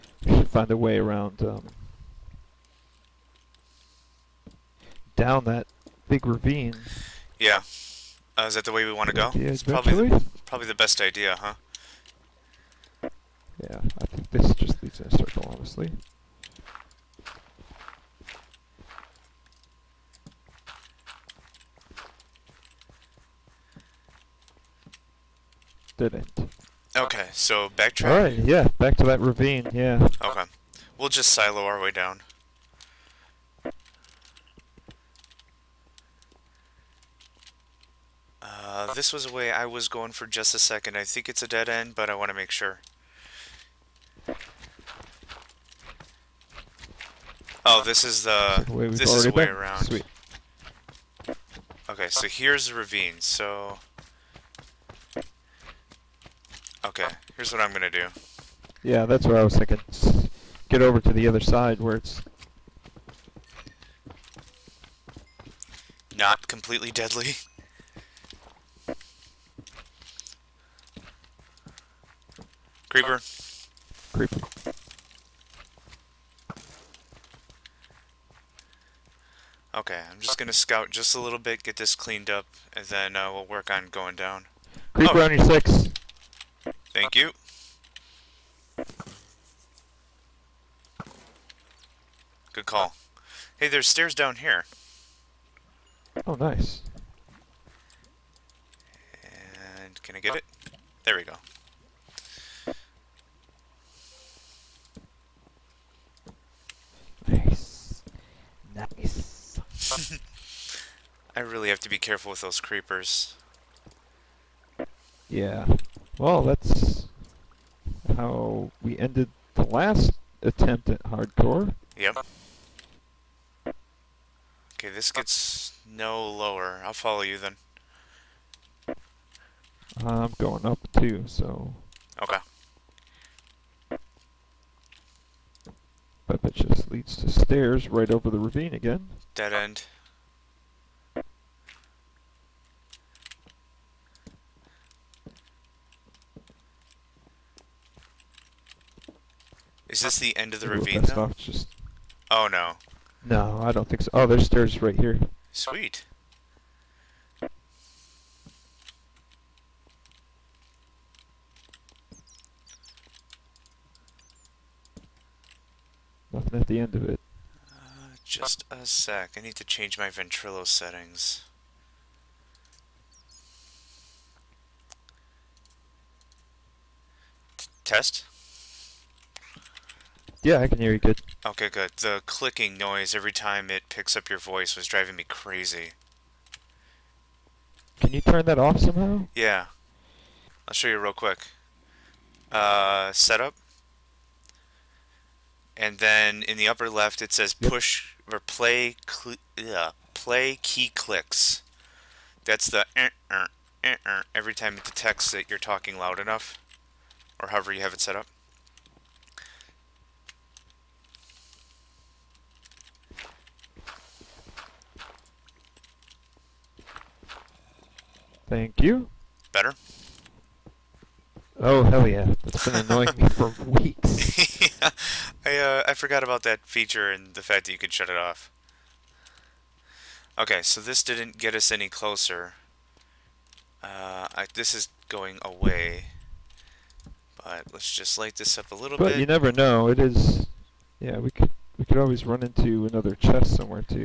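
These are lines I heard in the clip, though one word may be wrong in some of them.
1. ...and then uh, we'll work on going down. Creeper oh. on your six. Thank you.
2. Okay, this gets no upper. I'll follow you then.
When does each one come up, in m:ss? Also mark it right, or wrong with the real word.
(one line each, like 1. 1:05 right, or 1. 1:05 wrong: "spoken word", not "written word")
1. 1:22 right
2. 2:03 wrong: "lower", not "upper".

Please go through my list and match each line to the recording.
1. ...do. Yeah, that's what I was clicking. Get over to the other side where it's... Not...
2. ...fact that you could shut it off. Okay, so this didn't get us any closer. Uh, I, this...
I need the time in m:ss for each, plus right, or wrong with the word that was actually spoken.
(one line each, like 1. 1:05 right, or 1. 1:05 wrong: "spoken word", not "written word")
1. 0:57 wrong: "thinking", not "clicking"
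2. 3:47 right.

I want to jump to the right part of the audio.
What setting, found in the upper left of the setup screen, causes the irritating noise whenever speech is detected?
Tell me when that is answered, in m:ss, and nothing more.
3:20.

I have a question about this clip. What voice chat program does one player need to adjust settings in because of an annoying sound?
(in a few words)
Ventrilo.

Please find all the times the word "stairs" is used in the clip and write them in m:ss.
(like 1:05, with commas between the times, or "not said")
1:33, 2:17, 2:34.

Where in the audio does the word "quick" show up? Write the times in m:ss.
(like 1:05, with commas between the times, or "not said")
3:11.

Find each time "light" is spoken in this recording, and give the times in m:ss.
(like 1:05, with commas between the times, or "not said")
3:58.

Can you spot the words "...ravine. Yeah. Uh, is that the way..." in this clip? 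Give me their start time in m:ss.
0:06.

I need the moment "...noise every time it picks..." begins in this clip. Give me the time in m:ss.
3:02.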